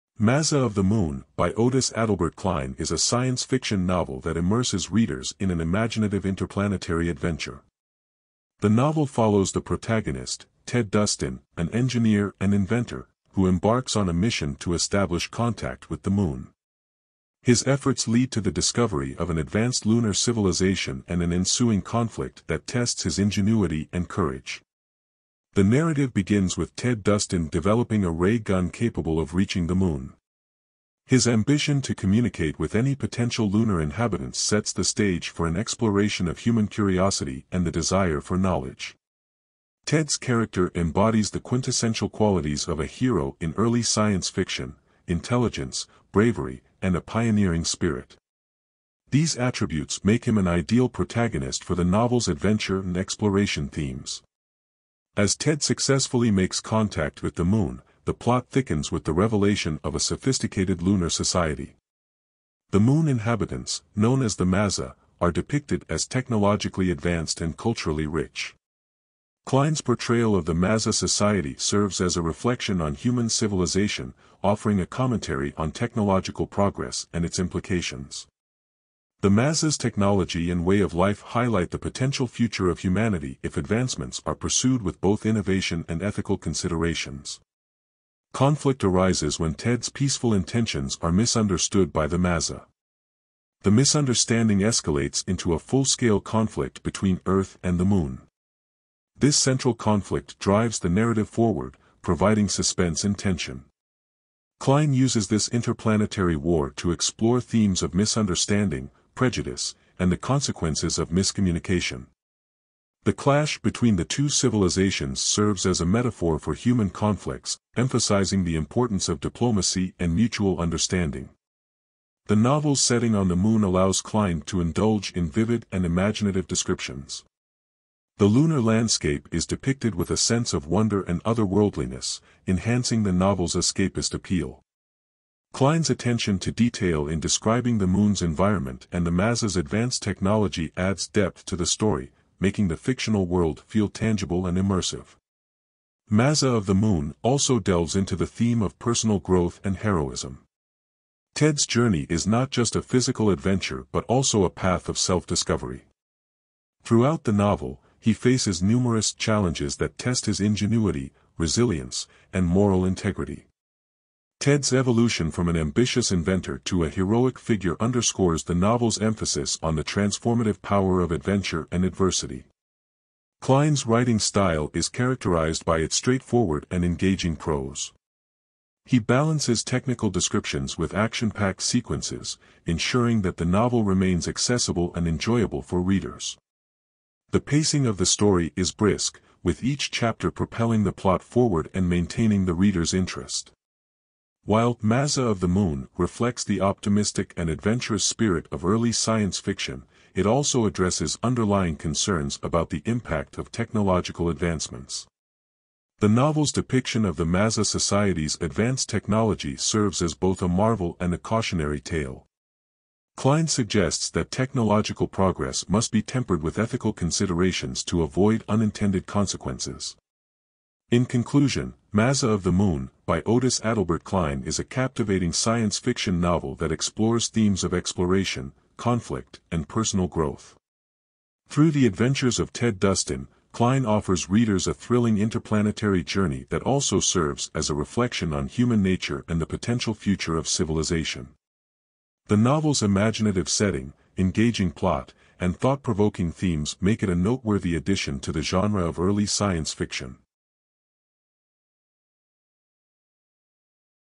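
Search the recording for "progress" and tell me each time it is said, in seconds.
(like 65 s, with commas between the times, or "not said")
76 s, 215 s.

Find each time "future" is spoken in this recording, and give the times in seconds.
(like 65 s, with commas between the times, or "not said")
82 s, 239 s.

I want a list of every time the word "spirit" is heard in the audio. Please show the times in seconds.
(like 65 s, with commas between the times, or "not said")
47 s, 198 s.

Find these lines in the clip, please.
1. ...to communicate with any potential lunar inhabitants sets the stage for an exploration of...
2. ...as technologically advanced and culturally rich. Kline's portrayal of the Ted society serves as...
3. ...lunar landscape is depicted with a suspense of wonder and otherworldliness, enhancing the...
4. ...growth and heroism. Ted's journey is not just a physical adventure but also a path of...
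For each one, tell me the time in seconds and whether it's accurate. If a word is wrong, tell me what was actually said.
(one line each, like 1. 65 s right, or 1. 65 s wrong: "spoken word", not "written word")
1. 31 s right
2. 65 s wrong: "Maza", not "Ted"
3. 128 s wrong: "sense", not "suspense"
4. 149 s right.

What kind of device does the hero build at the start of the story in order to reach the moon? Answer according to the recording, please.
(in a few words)
Ray gun.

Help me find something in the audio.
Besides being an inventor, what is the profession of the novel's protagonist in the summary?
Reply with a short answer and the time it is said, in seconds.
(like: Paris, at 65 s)
Engineer, at 11 s.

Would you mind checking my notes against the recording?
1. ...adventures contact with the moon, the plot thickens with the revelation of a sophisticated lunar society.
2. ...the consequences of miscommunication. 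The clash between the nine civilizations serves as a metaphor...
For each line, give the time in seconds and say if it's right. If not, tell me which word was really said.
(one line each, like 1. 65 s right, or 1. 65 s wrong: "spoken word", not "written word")
1. 56 s wrong: "makes", not "adventures"
2. 110 s wrong: "two", not "nine".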